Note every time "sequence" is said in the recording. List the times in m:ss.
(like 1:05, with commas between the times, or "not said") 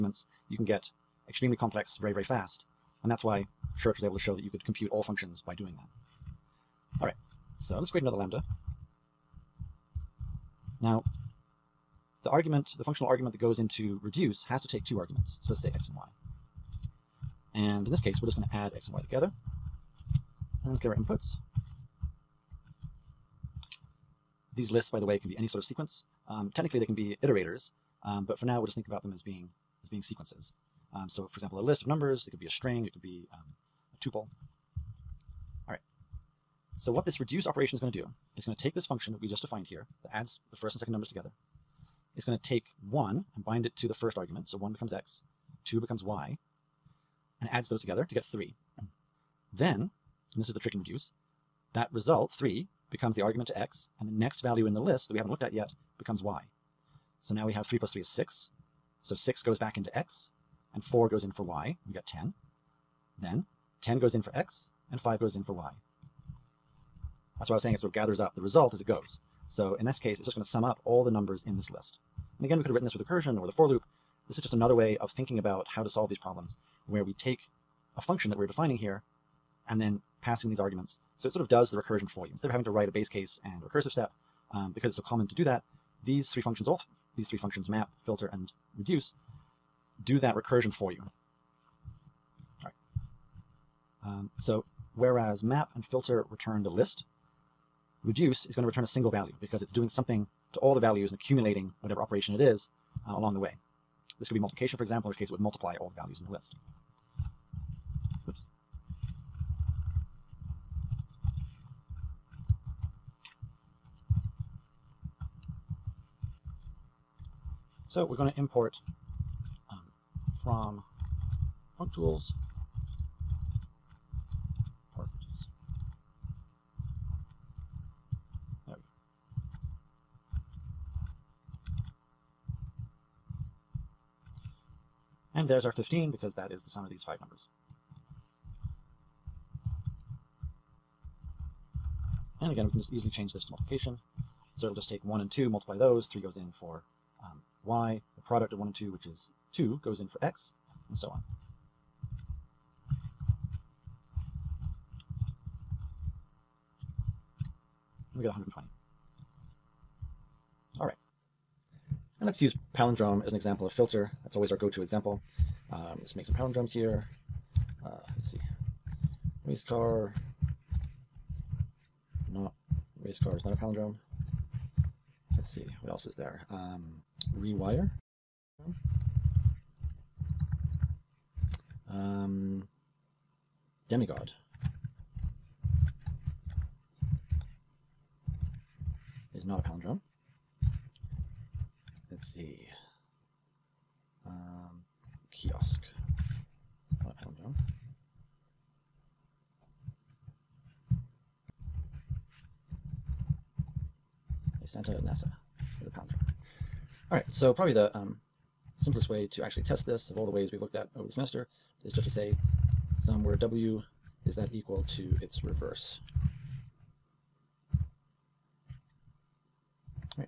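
0:25, 0:30.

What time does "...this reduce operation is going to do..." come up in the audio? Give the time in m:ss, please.
0:37.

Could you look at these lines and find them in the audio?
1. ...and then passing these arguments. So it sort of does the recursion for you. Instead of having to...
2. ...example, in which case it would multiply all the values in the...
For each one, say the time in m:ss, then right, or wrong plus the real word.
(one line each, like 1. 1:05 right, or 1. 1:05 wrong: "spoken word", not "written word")
1. 1:19 right
2. 1:44 right.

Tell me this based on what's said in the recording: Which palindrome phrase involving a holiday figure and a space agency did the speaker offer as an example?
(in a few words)
Santa Nasa.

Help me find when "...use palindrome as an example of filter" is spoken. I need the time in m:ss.
2:42.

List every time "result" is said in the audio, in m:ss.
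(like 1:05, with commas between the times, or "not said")
0:51, 1:08.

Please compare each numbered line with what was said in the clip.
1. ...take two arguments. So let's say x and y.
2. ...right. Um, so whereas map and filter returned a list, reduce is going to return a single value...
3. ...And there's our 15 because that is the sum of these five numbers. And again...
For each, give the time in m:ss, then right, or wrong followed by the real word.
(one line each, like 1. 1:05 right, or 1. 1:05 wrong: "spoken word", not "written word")
1. 0:14 right
2. 1:32 right
3. 2:15 right.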